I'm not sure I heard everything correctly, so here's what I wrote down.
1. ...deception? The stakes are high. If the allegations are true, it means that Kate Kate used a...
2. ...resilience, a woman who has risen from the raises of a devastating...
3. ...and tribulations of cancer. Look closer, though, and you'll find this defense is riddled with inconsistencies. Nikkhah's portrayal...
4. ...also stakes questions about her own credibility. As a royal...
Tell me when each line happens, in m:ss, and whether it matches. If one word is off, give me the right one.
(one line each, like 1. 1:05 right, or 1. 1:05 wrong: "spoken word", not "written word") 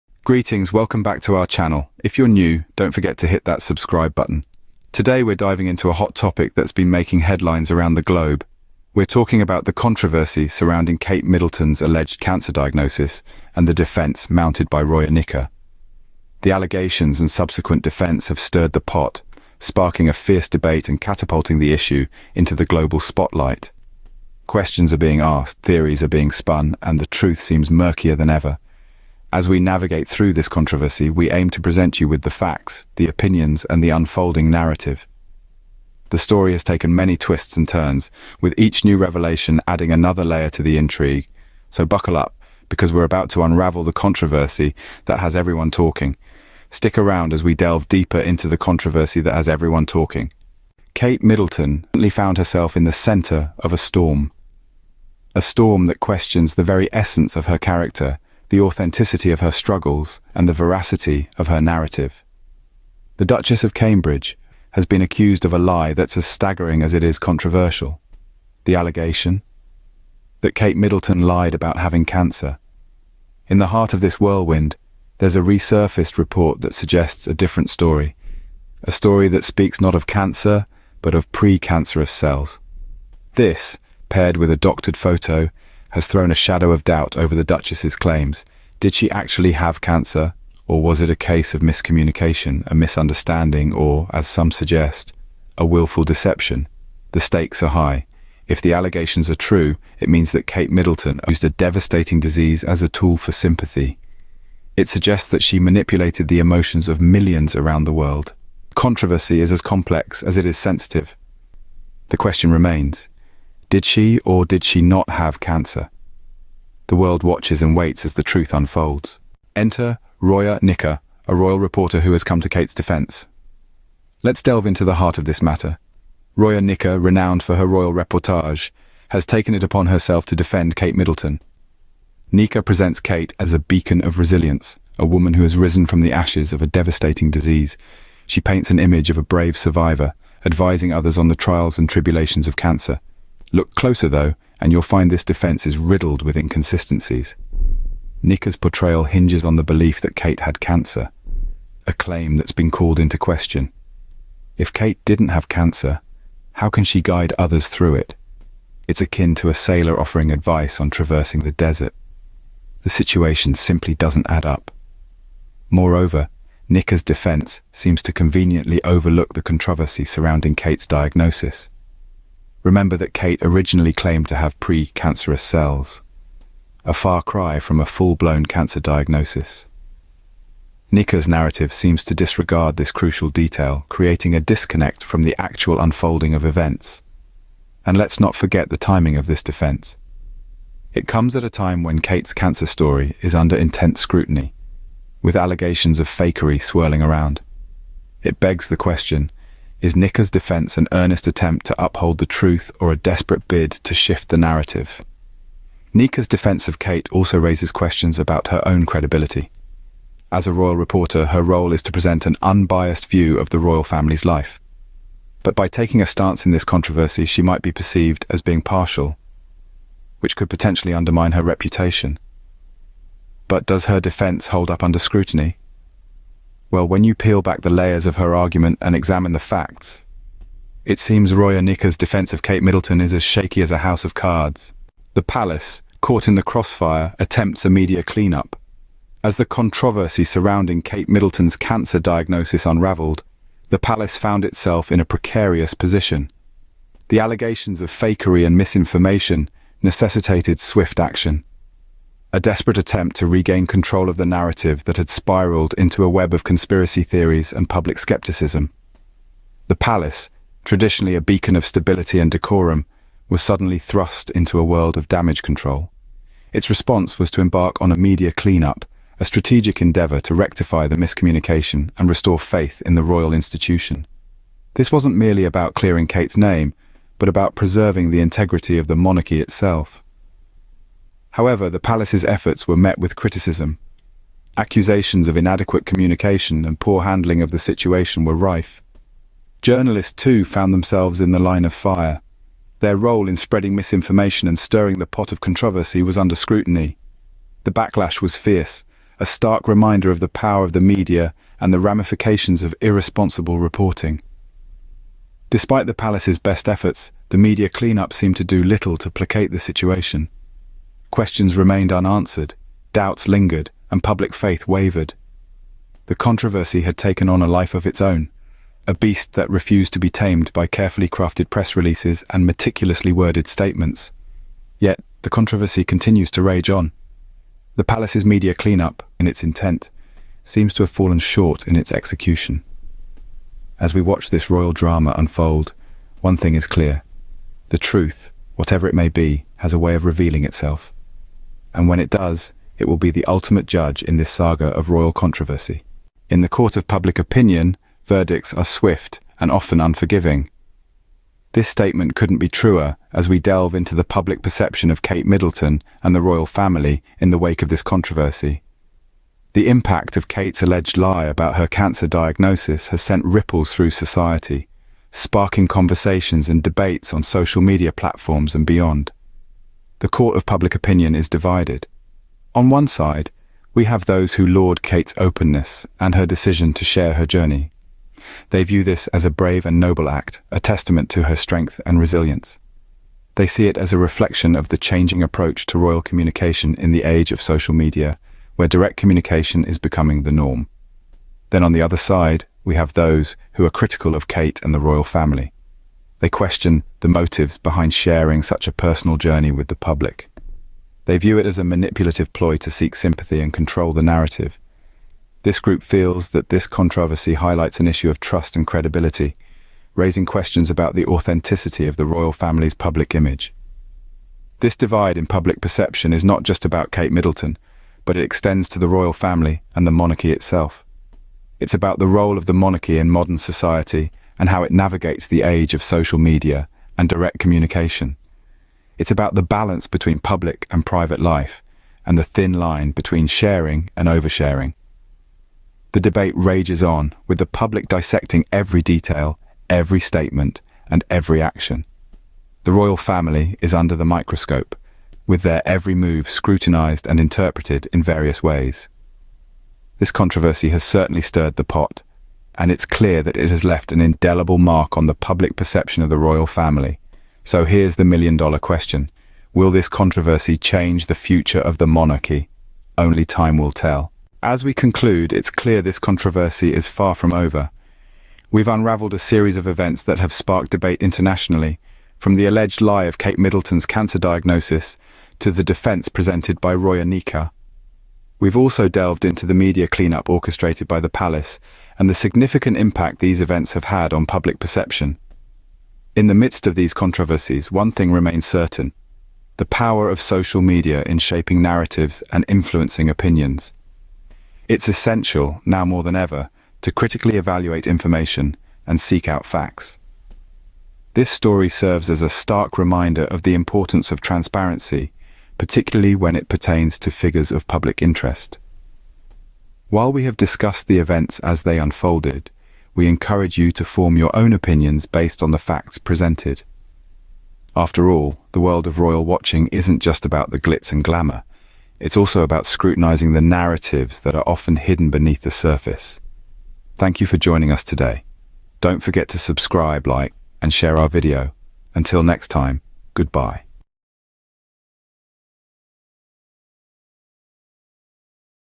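1. 1:36 wrong: "Middleton", not "Kate"
2. 2:14 wrong: "ashes", not "raises"
3. 2:21 right
4. 3:27 wrong: "raises", not "stakes".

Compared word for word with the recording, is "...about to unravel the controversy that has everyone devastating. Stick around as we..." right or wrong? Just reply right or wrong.
wrong.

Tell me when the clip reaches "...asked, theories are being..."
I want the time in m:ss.
0:25.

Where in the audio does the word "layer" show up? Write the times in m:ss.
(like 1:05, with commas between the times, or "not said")
0:40, 3:47.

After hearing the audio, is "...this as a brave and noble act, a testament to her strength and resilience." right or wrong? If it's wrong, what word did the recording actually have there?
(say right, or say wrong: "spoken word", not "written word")
right.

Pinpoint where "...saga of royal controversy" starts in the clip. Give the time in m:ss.
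5:44.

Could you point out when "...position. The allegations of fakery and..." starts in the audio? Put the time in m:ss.
4:05.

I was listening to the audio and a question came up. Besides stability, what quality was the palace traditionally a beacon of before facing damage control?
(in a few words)
decorum.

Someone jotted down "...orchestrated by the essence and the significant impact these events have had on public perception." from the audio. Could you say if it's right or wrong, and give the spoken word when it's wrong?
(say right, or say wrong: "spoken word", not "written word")
wrong: "palace", not "essence".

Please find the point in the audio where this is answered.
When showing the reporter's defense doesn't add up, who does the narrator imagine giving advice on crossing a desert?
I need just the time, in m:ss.
2:39.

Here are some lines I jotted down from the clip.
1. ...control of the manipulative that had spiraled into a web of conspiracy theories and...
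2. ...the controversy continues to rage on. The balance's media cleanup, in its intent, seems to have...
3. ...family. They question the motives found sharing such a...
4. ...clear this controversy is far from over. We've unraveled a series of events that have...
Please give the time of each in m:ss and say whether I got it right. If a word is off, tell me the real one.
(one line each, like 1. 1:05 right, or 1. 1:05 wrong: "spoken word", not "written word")
1. 4:13 wrong: "narrative", not "manipulative"
2. 5:25 wrong: "palace", not "balance"
3. 6:35 wrong: "behind", not "found"
4. 7:45 right.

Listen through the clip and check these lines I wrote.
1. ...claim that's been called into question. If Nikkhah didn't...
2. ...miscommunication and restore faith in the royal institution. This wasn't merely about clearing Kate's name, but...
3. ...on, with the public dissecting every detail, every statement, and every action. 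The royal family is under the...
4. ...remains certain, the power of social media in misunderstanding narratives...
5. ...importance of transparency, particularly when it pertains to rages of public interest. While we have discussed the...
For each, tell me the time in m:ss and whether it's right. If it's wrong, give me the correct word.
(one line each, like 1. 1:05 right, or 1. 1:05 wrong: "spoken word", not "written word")
1. 2:31 wrong: "Kate", not "Nikkhah"
2. 4:30 right
3. 7:16 right
4. 8:08 wrong: "shaping", not "misunderstanding"
5. 8:23 wrong: "figures", not "rages".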